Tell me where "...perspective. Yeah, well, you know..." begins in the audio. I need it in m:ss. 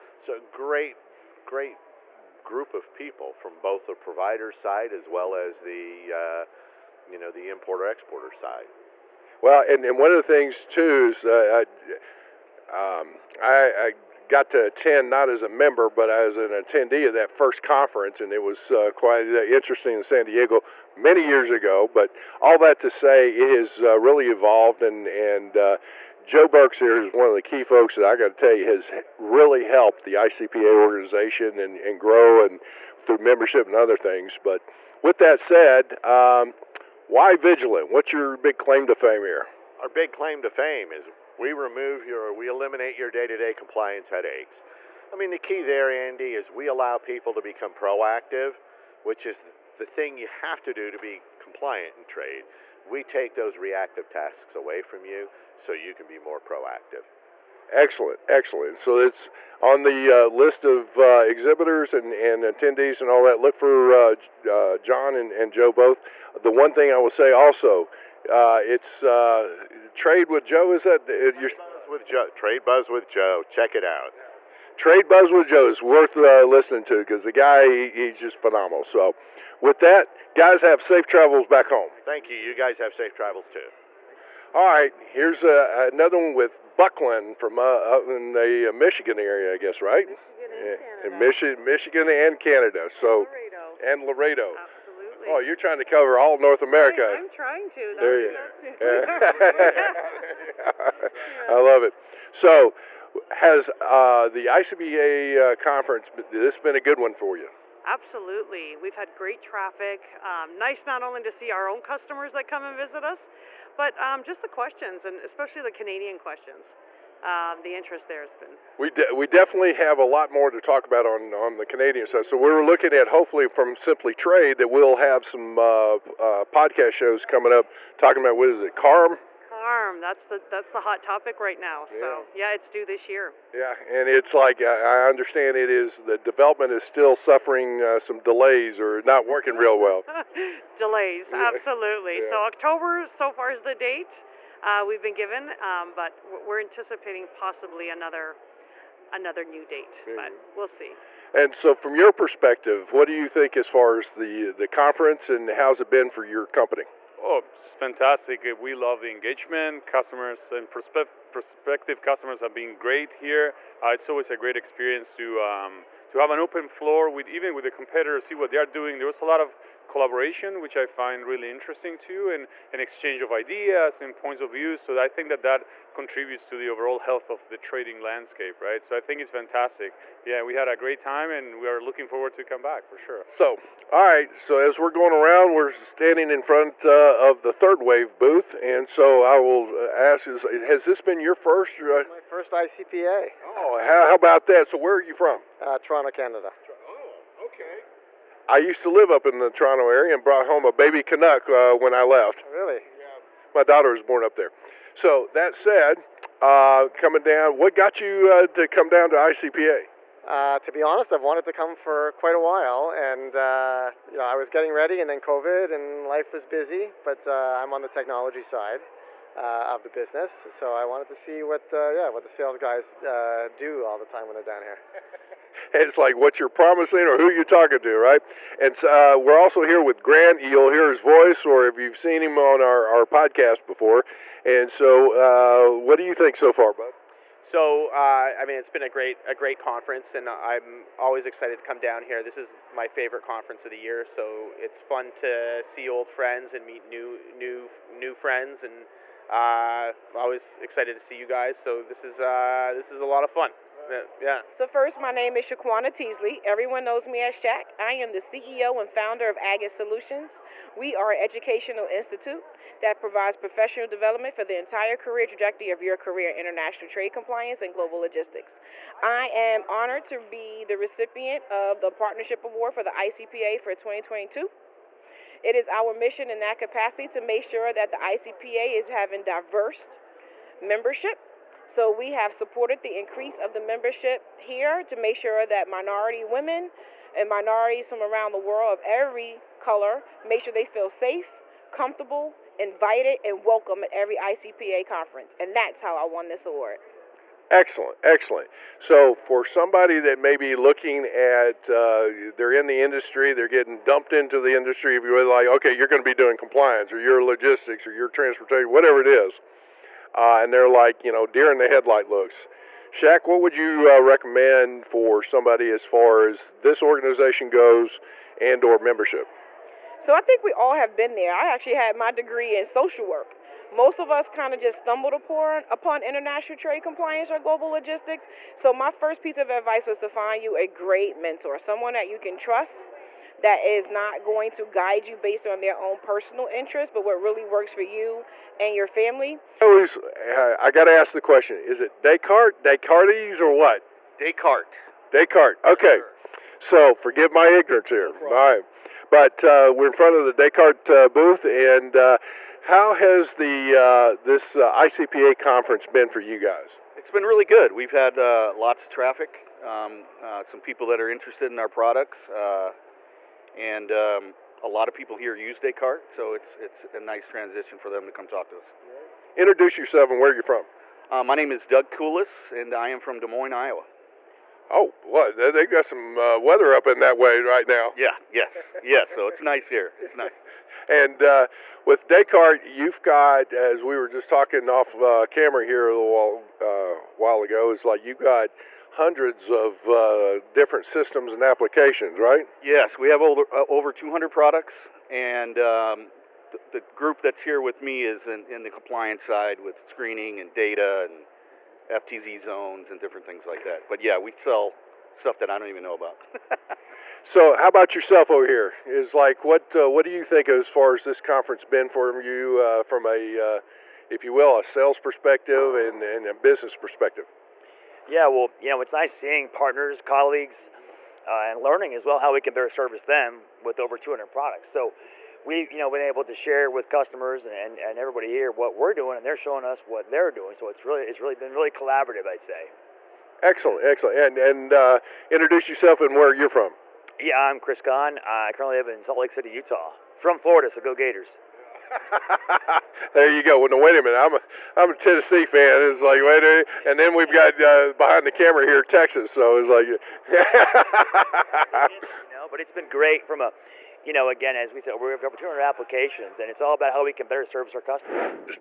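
6:56.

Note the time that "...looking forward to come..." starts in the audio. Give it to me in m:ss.
3:01.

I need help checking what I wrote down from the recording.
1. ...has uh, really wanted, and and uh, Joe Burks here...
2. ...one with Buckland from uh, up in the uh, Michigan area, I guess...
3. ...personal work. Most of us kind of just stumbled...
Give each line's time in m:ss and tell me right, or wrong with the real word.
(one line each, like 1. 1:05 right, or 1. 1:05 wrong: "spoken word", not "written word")
1. 0:23 wrong: "evolved", not "wanted"
2. 1:26 right
3. 5:22 wrong: "social", not "personal".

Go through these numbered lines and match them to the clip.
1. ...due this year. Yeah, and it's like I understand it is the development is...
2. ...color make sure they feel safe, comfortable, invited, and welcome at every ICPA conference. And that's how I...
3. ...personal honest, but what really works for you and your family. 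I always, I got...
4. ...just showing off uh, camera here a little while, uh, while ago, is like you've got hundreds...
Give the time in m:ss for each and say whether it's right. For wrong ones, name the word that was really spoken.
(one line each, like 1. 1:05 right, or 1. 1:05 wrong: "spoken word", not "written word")
1. 2:12 right
2. 4:49 right
3. 5:35 wrong: "interest", not "honest"
4. 6:24 wrong: "talking", not "showing".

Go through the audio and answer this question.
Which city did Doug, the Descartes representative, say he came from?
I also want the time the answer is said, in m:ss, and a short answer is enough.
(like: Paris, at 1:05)
Des Moines, Iowa, at 6:13.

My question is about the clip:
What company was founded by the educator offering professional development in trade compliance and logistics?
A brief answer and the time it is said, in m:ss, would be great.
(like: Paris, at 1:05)
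Agate Solutions, at 4:19.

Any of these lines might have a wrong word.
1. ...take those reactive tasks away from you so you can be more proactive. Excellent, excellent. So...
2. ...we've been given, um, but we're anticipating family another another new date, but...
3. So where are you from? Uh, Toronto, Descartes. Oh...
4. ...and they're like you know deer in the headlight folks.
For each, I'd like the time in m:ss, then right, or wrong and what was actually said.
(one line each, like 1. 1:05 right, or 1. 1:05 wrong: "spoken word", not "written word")
1. 0:53 right
2. 2:24 wrong: "possibly", not "family"
3. 3:14 wrong: "Canada", not "Descartes"
4. 5:10 wrong: "looks", not "folks".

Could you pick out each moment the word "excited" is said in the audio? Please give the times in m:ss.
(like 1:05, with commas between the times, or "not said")
4:01, 4:10.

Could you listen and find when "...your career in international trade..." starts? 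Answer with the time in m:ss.
4:25.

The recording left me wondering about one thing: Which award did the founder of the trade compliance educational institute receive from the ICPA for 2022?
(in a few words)
Partnership Award.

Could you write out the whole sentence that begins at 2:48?
There was a lot of collaboration, which I find really interesting too, and an exchange of ideas and points of view.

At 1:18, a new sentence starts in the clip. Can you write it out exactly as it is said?
So, with that, guys, have safe travels back home.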